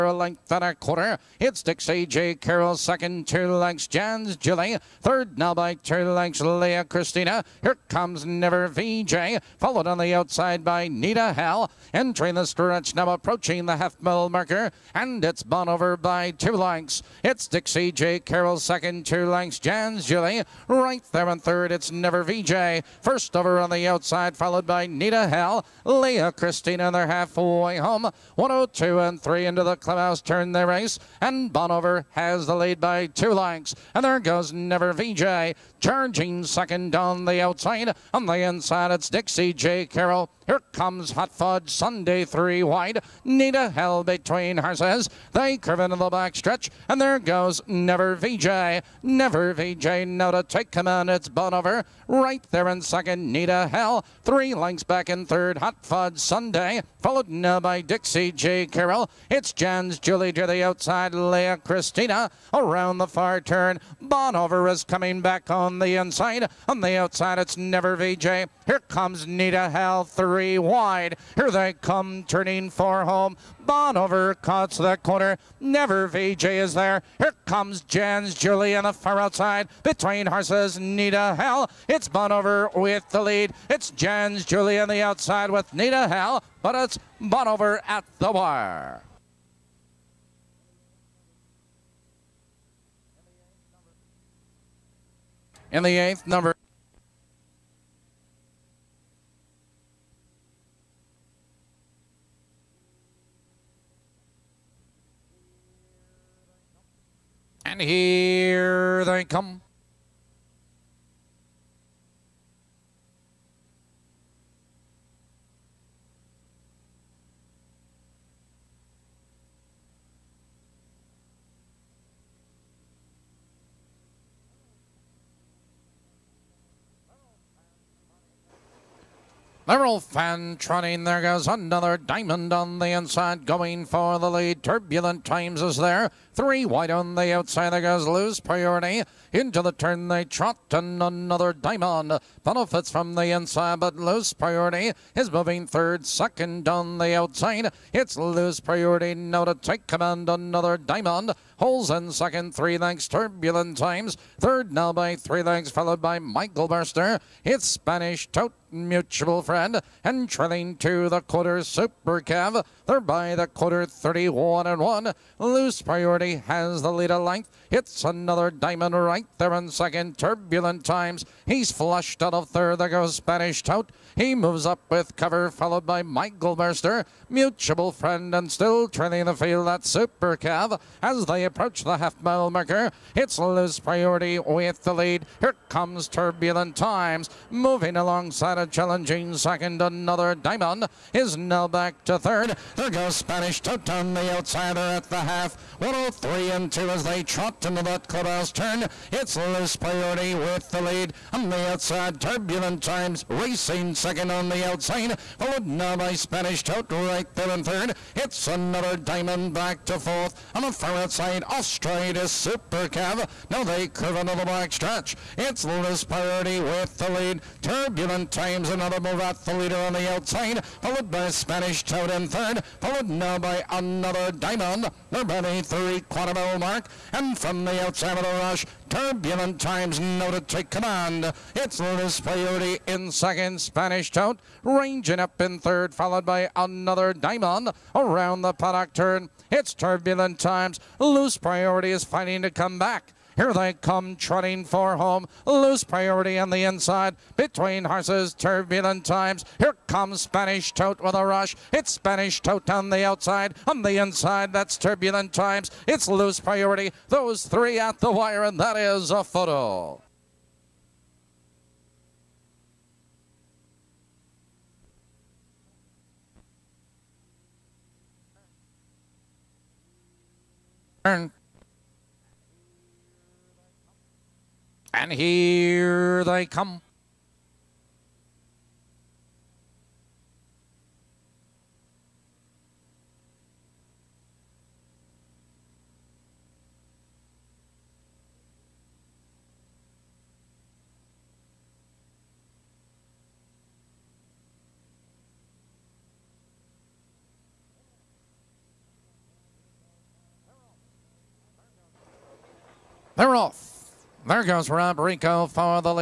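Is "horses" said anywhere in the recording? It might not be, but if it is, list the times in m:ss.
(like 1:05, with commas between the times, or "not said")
0:44, 1:20, 4:07.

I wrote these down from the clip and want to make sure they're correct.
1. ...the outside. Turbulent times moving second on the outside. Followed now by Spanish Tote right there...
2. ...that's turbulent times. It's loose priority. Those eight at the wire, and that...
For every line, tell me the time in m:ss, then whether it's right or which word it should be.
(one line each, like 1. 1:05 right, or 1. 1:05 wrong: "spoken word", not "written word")
1. 3:21 wrong: "racing", not "moving"
2. 4:14 wrong: "three", not "eight".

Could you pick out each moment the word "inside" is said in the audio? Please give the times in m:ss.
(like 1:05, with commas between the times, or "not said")
0:38, 1:05, 2:12, 2:23, 4:06, 4:13.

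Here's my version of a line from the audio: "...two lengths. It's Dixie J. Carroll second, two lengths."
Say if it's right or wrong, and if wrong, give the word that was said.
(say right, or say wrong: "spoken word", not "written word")
right.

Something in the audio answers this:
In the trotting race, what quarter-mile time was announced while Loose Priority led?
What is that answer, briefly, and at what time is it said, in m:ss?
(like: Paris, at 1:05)
31 and 1, at 2:43.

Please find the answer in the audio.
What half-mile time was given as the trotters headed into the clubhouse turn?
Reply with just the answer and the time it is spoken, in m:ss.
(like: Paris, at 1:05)
1:03 2/5, at 3:15.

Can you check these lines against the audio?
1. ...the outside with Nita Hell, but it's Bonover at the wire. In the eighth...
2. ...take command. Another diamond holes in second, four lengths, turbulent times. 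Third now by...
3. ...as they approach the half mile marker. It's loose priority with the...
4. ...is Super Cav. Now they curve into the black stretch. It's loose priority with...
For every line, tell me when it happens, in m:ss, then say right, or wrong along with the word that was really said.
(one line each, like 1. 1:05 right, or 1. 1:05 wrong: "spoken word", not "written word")
1. 1:24 right
2. 2:29 wrong: "three", not "four"
3. 3:01 right
4. 3:32 right.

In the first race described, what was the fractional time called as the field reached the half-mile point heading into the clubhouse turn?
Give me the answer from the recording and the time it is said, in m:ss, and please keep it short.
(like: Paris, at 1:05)
1:02 3/5, at 0:28.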